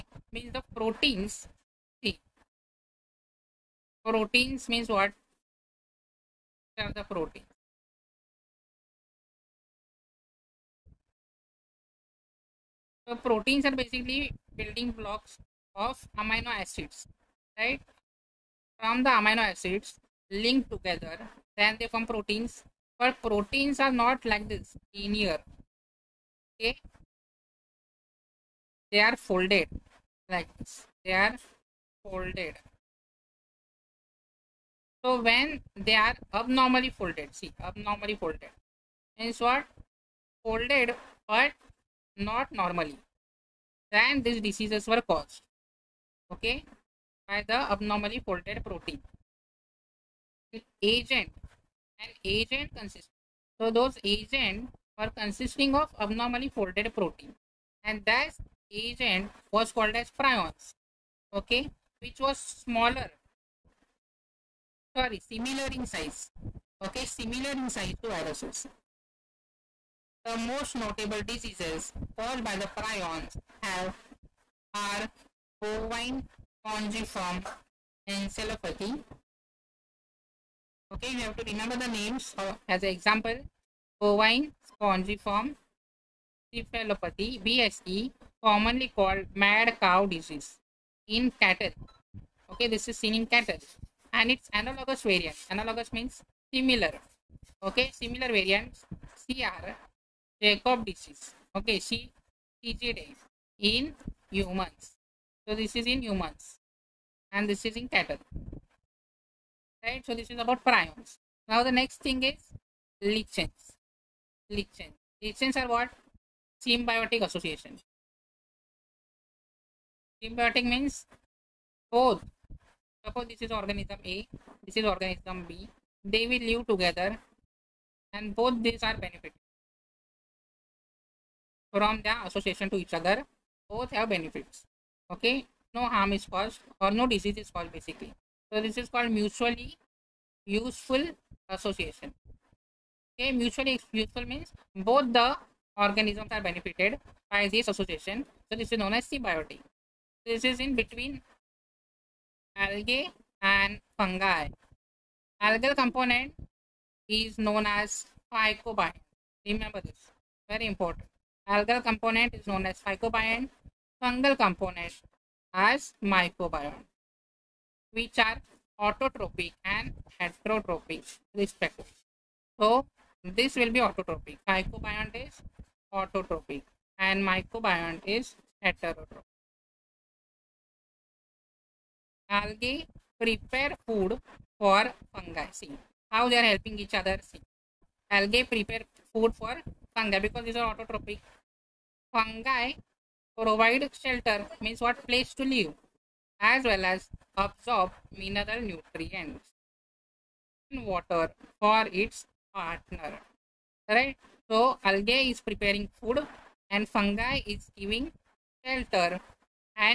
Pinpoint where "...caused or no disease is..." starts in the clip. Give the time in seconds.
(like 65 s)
136 s.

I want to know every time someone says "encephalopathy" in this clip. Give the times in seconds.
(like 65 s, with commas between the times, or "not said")
78 s, 86 s.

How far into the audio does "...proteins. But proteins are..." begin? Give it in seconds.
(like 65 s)
22 s.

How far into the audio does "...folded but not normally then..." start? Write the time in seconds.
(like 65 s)
40 s.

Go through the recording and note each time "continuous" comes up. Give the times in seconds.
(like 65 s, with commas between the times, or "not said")
not said.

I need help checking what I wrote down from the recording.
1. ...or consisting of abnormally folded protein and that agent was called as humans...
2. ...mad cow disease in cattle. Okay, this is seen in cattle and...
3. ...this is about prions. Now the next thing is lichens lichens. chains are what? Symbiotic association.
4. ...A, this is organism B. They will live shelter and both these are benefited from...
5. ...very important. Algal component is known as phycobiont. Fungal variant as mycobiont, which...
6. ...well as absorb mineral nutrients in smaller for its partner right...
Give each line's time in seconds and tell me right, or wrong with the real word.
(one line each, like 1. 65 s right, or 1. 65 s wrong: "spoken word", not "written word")
1. 54 s wrong: "prions", not "humans"
2. 89 s right
3. 110 s right
4. 124 s wrong: "together", not "shelter"
5. 160 s wrong: "component", not "variant"
6. 196 s wrong: "water", not "smaller".